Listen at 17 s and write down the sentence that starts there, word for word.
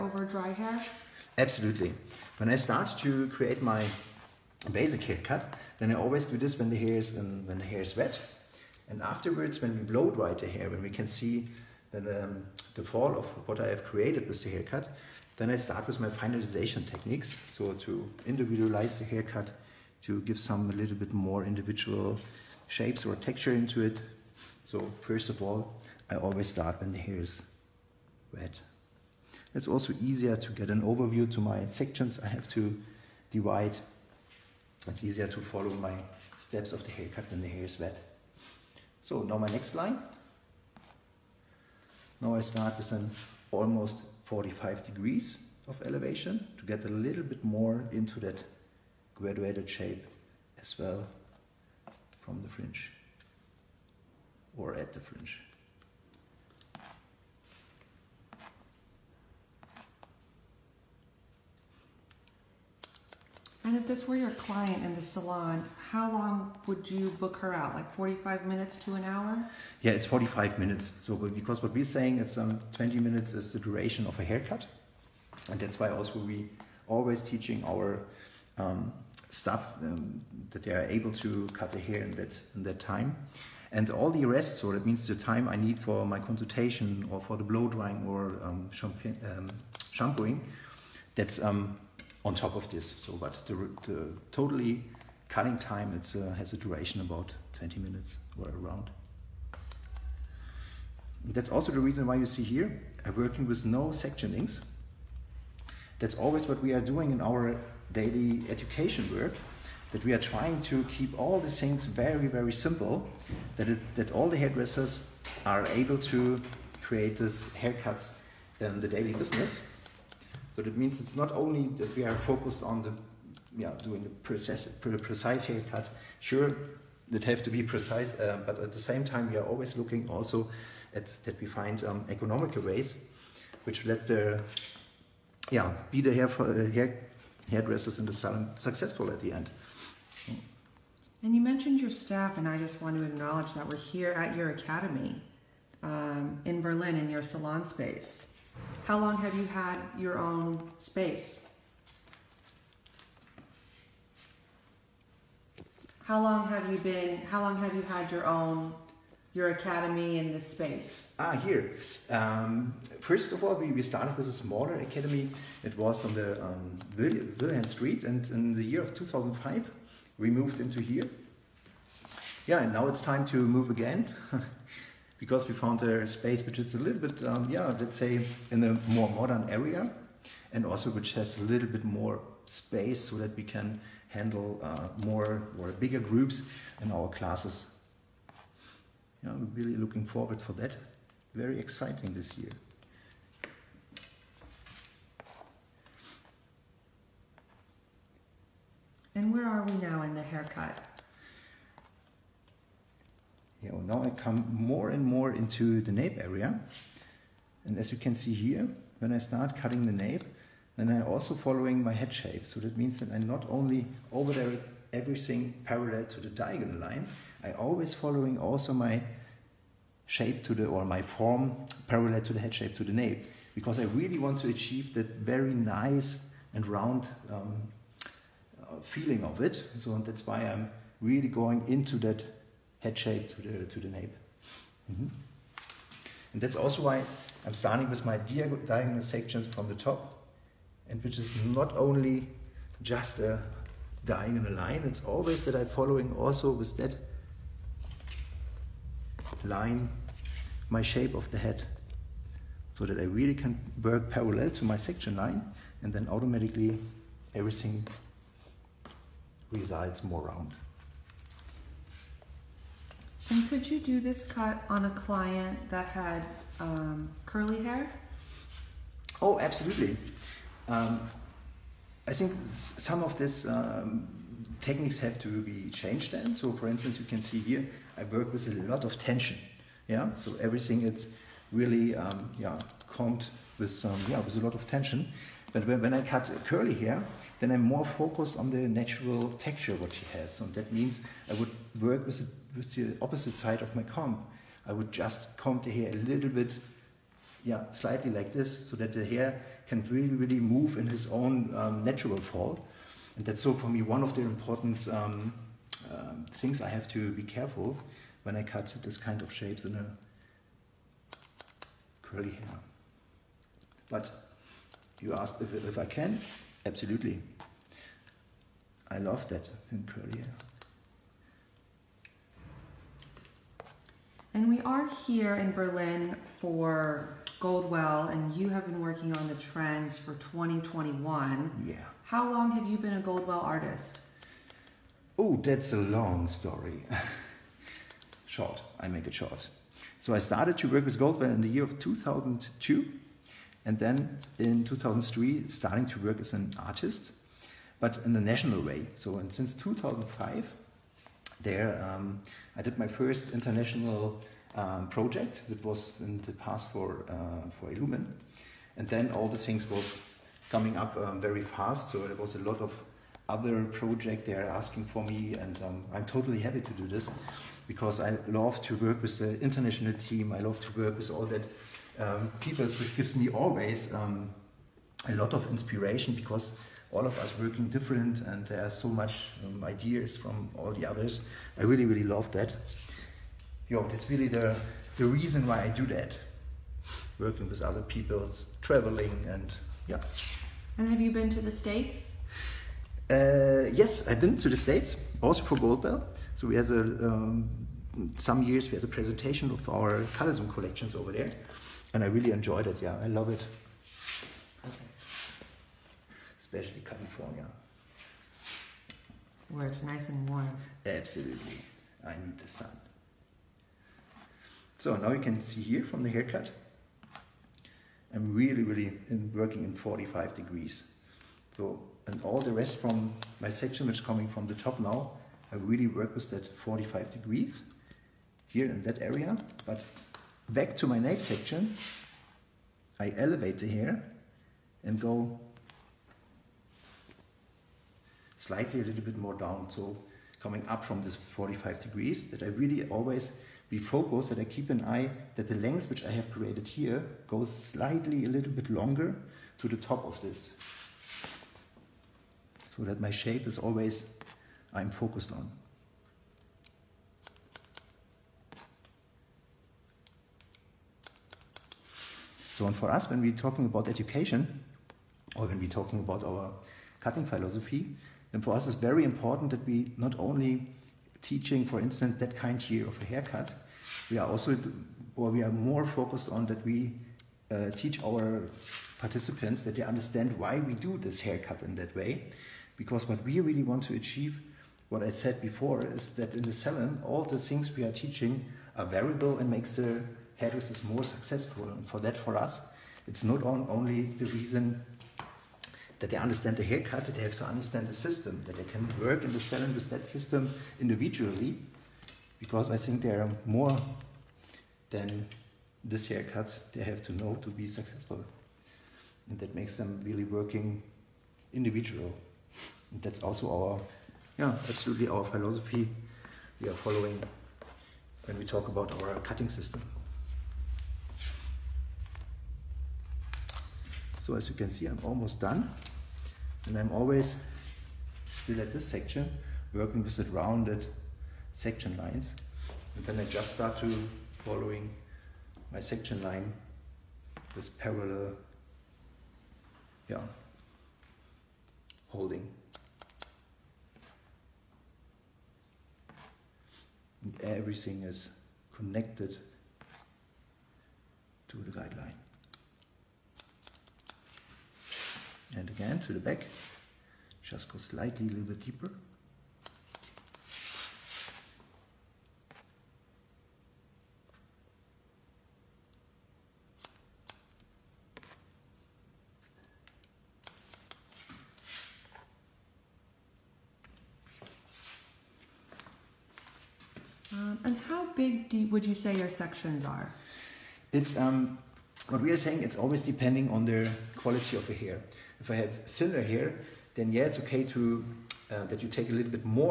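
So to individualize the haircut, to give some a little bit more individual shapes or texture into it.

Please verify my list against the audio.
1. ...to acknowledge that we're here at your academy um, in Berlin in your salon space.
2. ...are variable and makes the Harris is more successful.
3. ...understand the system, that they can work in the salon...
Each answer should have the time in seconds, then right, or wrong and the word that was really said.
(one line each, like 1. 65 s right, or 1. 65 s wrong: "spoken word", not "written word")
1. 142 s right
2. 488 s right
3. 497 s right.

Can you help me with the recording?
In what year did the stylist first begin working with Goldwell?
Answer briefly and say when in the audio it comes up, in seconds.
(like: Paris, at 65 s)
2002, at 341 s.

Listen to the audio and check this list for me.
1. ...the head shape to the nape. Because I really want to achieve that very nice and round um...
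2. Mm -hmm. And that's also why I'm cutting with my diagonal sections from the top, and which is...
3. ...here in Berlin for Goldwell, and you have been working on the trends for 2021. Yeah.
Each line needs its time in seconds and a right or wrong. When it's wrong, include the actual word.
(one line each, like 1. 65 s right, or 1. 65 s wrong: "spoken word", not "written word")
1. 222 s right
2. 234 s wrong: "starting", not "cutting"
3. 325 s right.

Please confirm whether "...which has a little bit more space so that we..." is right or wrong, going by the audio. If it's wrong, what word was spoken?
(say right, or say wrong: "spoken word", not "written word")
right.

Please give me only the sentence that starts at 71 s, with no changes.
So because what we're saying is um, 20 minutes is the duration of a haircut.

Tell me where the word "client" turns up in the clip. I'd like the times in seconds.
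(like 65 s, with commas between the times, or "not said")
64 s, 264 s.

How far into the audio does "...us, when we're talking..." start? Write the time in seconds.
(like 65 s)
462 s.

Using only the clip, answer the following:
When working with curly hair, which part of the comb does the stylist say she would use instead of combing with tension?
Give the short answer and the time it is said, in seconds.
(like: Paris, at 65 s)
the opposite side, at 293 s.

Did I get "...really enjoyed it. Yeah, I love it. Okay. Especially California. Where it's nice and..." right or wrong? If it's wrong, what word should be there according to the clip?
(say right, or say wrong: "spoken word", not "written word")
right.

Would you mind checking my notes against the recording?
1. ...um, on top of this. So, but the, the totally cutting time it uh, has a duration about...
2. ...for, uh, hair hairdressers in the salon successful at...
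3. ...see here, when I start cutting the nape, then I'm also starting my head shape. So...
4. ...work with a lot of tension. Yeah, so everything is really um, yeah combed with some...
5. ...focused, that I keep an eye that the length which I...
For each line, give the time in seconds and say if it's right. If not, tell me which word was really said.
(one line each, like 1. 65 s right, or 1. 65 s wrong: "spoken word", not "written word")
1. 91 s right
2. 136 s right
3. 208 s wrong: "following", not "starting"
4. 278 s right
5. 443 s right.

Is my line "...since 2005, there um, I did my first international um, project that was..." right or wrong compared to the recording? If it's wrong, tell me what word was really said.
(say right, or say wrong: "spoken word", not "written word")
right.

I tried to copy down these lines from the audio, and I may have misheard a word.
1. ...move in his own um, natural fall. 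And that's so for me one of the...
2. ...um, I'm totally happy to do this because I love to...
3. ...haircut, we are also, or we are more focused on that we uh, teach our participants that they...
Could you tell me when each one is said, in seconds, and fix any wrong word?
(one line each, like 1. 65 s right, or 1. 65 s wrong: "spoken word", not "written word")
1. 300 s right
2. 365 s right
3. 473 s right.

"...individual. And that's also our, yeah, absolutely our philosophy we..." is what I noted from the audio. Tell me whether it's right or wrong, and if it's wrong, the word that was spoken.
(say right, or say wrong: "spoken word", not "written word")
right.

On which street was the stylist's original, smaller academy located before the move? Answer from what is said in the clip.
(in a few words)
Wilhelm Street.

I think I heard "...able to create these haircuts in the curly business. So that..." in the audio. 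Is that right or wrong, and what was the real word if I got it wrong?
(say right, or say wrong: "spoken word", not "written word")
wrong: "daily", not "curly".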